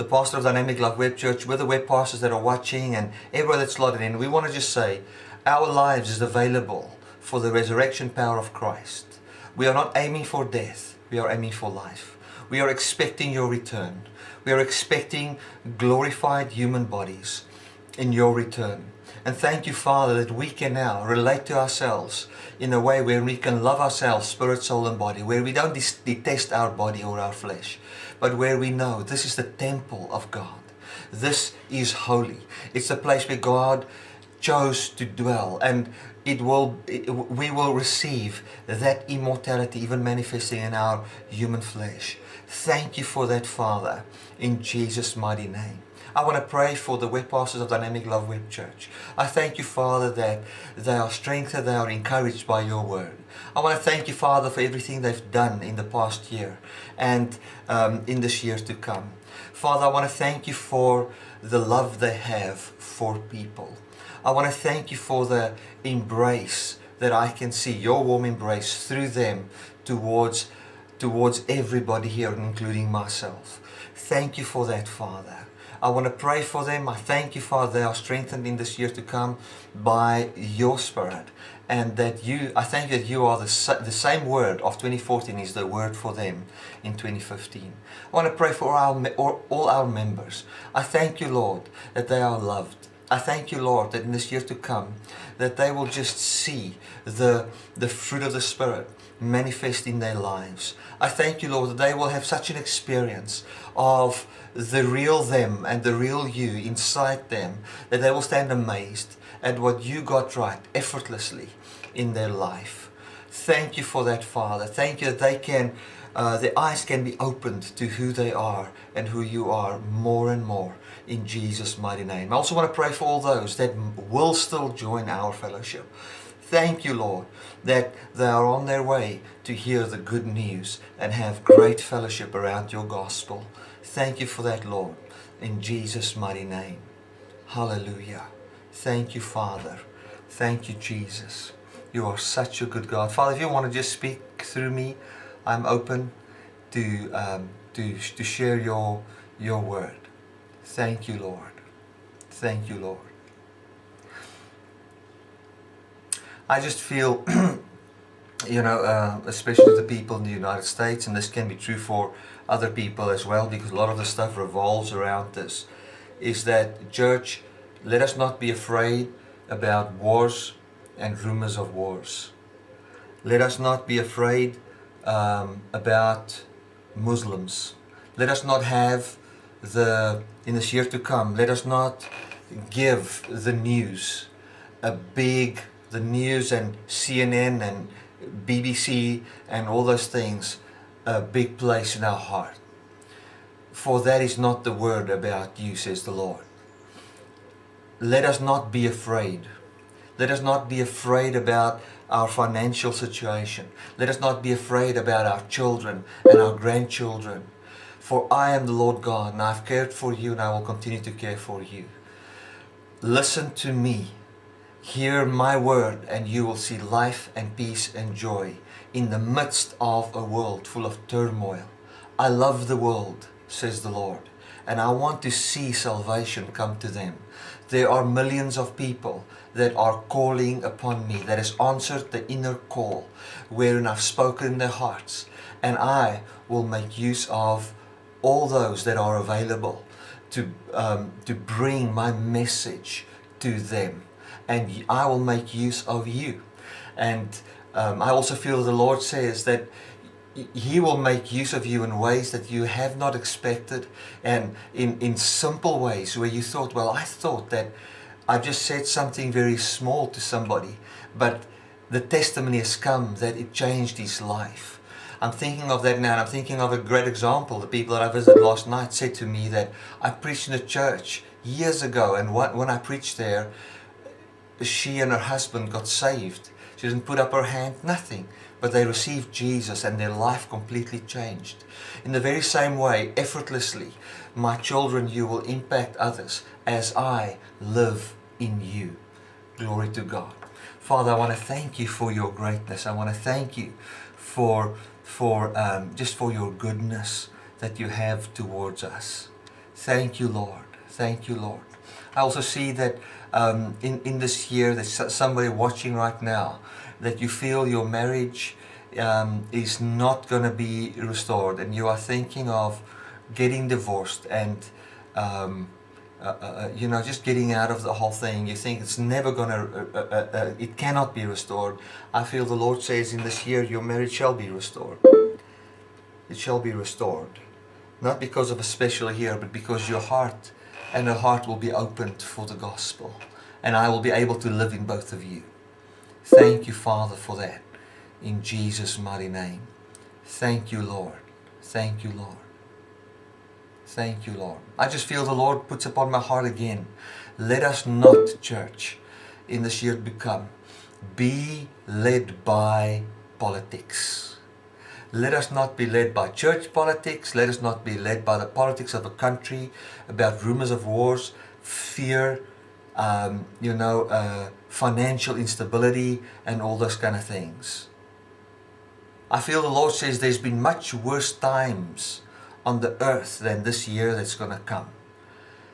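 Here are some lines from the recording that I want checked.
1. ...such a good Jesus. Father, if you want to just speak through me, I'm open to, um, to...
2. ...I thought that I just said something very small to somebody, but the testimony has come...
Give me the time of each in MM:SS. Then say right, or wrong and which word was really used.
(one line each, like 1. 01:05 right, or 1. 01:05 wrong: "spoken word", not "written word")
1. 02:22 wrong: "God", not "Jesus"
2. 04:16 right.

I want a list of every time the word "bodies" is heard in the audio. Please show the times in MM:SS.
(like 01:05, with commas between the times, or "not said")
00:16.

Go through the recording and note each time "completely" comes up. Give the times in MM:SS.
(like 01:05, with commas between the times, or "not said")
04:40.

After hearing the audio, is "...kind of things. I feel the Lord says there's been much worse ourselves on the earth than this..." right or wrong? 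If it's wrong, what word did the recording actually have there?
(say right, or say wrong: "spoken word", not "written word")
wrong: "times", not "ourselves".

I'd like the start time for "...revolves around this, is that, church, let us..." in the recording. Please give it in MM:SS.
02:44.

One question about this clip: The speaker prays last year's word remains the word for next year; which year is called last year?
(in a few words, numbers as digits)
2014.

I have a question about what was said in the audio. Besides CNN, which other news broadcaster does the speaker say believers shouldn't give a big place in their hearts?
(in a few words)
BBC.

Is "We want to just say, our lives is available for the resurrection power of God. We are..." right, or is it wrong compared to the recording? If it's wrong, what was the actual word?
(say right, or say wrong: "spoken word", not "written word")
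wrong: "Christ", not "God".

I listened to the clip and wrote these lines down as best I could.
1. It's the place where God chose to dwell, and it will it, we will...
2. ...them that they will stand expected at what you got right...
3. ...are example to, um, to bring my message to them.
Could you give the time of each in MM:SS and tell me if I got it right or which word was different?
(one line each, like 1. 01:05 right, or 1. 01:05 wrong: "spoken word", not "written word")
1. 00:32 right
2. 01:47 wrong: "amazed", not "expected"
3. 03:58 wrong: "available", not "example".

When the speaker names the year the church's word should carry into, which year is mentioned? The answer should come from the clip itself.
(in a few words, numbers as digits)
2015.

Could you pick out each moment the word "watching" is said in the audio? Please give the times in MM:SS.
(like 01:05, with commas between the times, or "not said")
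00:02, 05:05.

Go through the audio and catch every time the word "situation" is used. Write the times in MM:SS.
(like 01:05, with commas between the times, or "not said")
03:22.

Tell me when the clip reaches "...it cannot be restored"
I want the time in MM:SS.
05:20.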